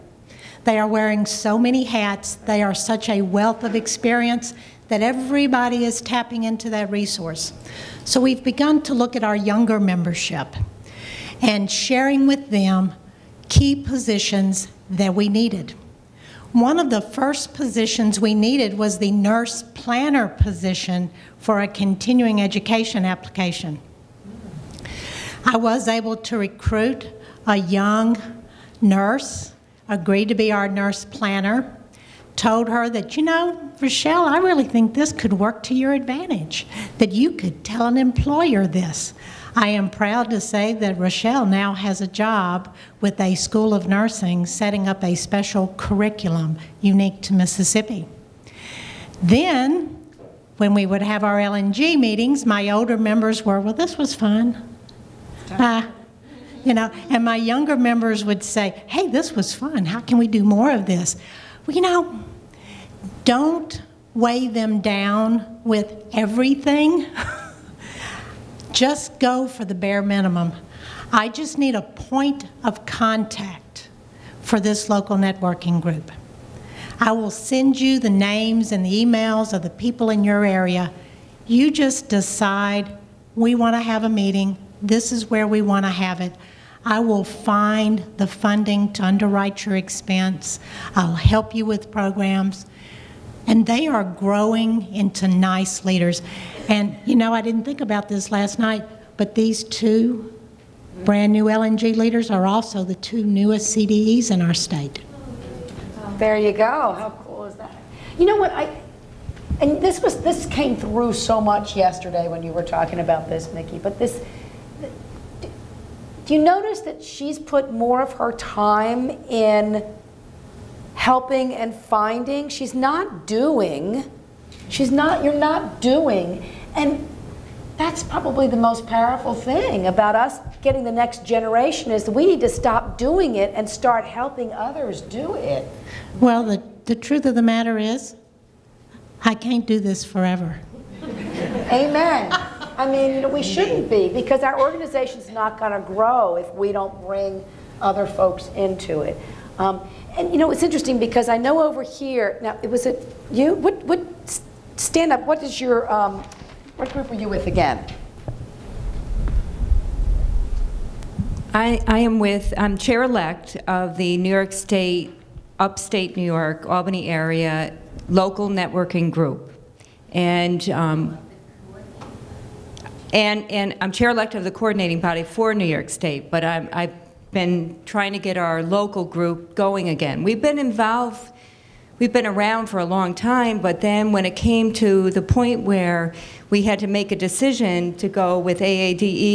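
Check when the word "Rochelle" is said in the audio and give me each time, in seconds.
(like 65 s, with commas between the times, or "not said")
33 s, 40 s.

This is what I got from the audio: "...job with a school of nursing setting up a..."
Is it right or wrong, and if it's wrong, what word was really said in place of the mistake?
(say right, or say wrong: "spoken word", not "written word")
right.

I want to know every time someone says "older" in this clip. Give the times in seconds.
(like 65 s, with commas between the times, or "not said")
52 s.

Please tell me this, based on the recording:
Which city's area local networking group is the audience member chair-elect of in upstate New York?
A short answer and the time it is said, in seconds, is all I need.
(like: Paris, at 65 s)
Albany, at 166 s.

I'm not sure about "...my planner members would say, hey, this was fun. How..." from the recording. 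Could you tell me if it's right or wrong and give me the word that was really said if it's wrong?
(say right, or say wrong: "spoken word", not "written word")
wrong: "younger", not "planner".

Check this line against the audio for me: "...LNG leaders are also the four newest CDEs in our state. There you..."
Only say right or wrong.
wrong.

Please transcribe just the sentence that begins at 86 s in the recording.
I will find the funding to underwrite your expense.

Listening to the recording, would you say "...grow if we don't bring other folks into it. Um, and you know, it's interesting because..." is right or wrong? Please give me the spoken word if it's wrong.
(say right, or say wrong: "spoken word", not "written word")
right.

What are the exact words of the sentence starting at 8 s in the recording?
So we've begun to look at our younger membership and sharing with them key positions that we needed.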